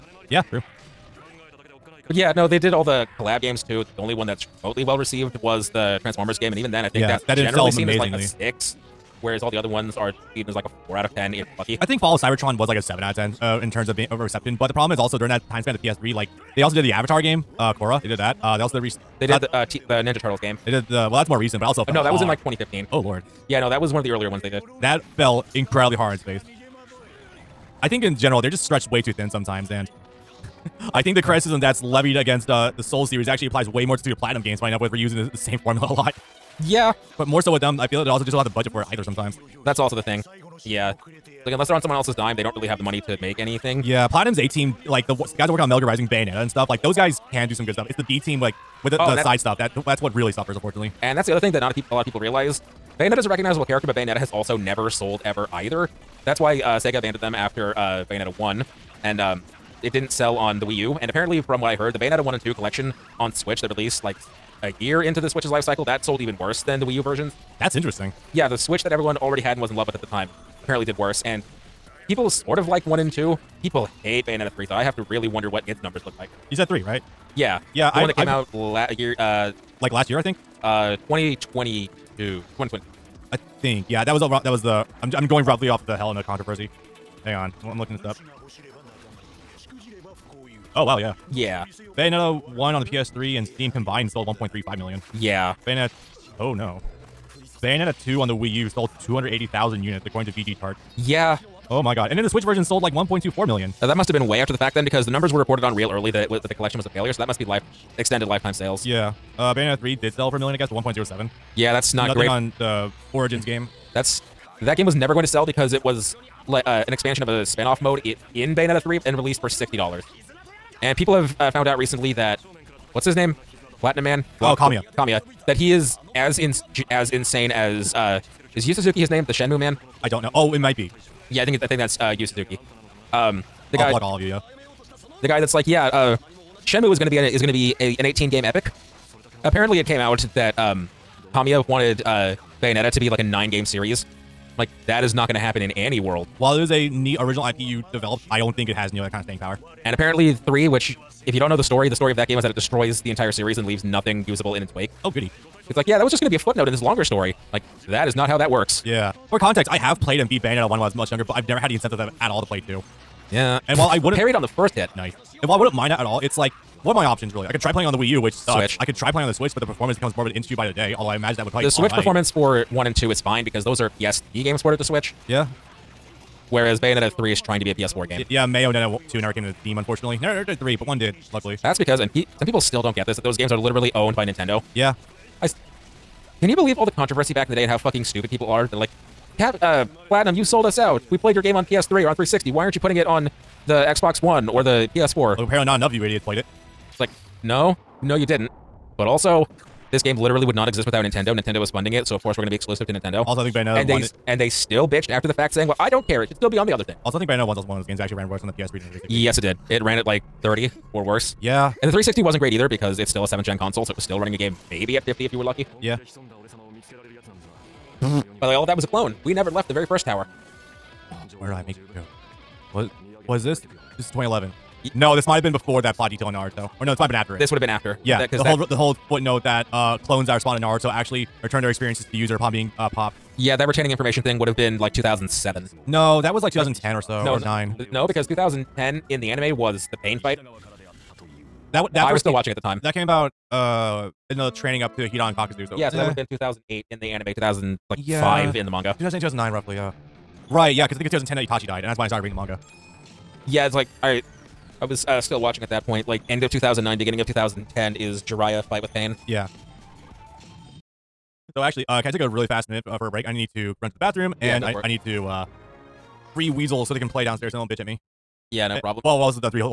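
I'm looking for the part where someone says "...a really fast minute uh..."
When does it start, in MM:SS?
04:22.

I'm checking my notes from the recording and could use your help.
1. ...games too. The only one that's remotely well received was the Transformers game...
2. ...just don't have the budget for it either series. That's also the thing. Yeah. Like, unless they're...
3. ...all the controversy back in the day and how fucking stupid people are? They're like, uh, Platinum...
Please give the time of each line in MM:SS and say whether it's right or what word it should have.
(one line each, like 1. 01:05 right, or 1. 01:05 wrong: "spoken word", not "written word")
1. 00:03 right
2. 00:38 wrong: "sometimes", not "series"
3. 03:06 right.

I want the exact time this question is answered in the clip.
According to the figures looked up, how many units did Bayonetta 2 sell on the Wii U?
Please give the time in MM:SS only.
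01:39.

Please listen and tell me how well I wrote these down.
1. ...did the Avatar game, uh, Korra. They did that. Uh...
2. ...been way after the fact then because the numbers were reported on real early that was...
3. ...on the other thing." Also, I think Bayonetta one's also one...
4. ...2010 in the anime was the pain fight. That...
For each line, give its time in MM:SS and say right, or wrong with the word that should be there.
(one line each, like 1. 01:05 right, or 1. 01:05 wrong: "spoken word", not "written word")
1. 00:16 right
2. 01:44 right
3. 03:26 right
4. 03:58 right.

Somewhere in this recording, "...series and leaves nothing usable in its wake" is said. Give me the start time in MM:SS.
02:33.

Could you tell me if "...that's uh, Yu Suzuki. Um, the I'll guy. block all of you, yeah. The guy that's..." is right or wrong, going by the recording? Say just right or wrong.
right.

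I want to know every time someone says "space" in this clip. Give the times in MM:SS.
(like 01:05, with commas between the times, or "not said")
00:26.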